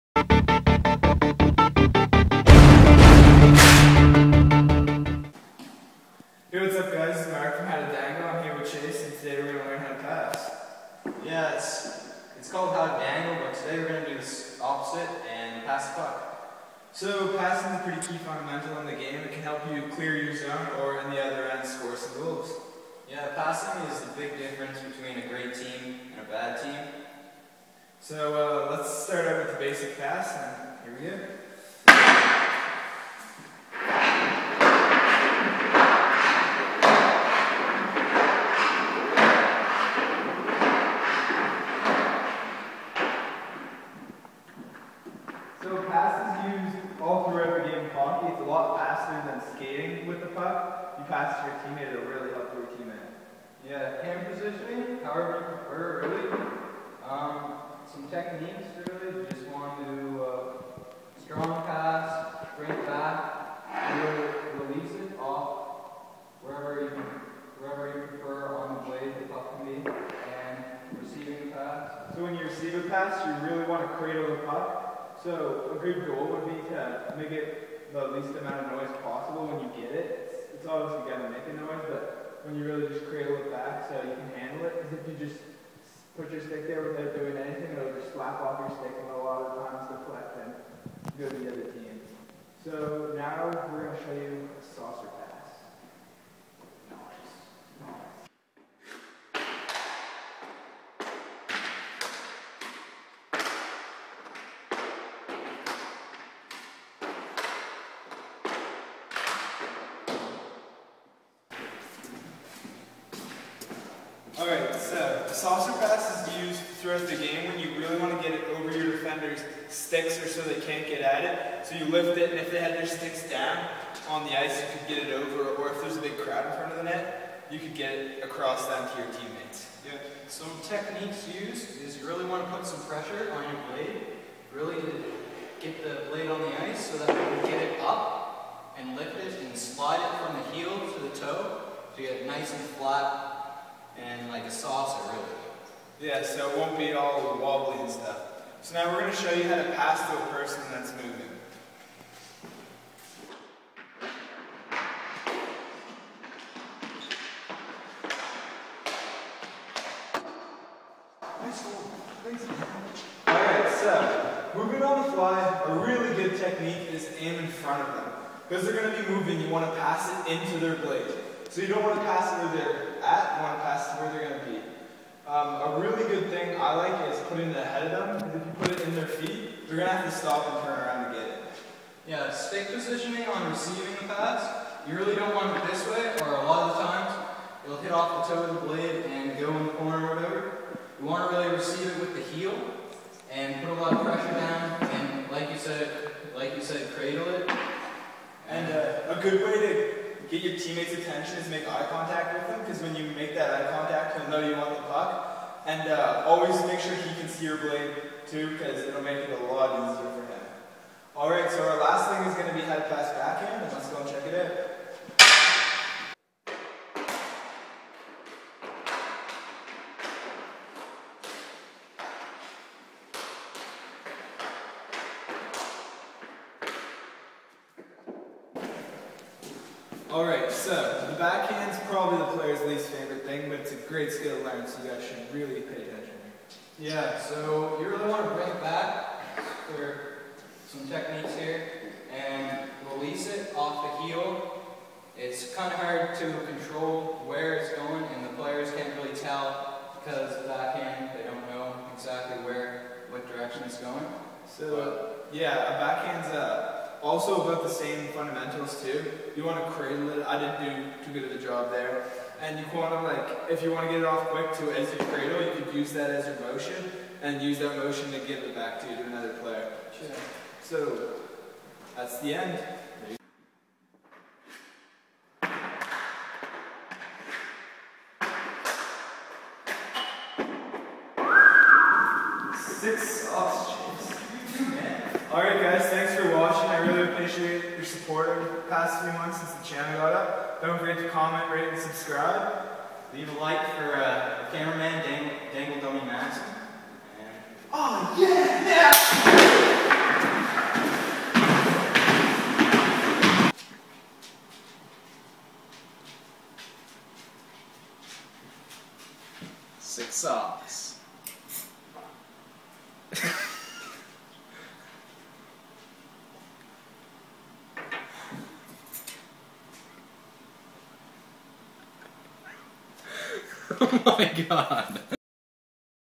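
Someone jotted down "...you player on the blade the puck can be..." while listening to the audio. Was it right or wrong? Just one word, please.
wrong.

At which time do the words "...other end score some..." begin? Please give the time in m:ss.
0:21.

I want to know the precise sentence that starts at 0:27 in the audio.
So uh, let's start out with the basic pass, and here we go.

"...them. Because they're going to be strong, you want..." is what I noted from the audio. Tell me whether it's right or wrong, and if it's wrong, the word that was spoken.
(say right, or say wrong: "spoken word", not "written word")
wrong: "moving", not "strong".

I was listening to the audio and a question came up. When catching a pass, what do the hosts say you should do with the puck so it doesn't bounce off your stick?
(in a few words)
Cradle the puck.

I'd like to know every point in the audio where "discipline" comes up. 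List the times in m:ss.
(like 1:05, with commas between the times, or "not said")
not said.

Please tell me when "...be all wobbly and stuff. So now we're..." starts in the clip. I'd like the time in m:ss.
2:26.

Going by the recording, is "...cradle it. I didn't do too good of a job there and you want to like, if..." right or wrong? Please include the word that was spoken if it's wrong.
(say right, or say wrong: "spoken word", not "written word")
right.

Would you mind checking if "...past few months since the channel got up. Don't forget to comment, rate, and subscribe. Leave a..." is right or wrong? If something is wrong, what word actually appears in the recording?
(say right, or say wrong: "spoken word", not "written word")
right.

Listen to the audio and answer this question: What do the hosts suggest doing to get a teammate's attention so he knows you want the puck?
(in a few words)
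Make eye contact.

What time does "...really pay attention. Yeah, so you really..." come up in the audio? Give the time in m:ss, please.
3:55.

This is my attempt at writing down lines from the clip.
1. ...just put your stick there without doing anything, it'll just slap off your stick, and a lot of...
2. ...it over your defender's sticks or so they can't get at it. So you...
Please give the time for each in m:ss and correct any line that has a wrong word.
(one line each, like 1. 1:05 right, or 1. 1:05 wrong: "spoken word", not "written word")
1. 1:25 right
2. 1:58 right.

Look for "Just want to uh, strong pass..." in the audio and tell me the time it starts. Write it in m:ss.
0:59.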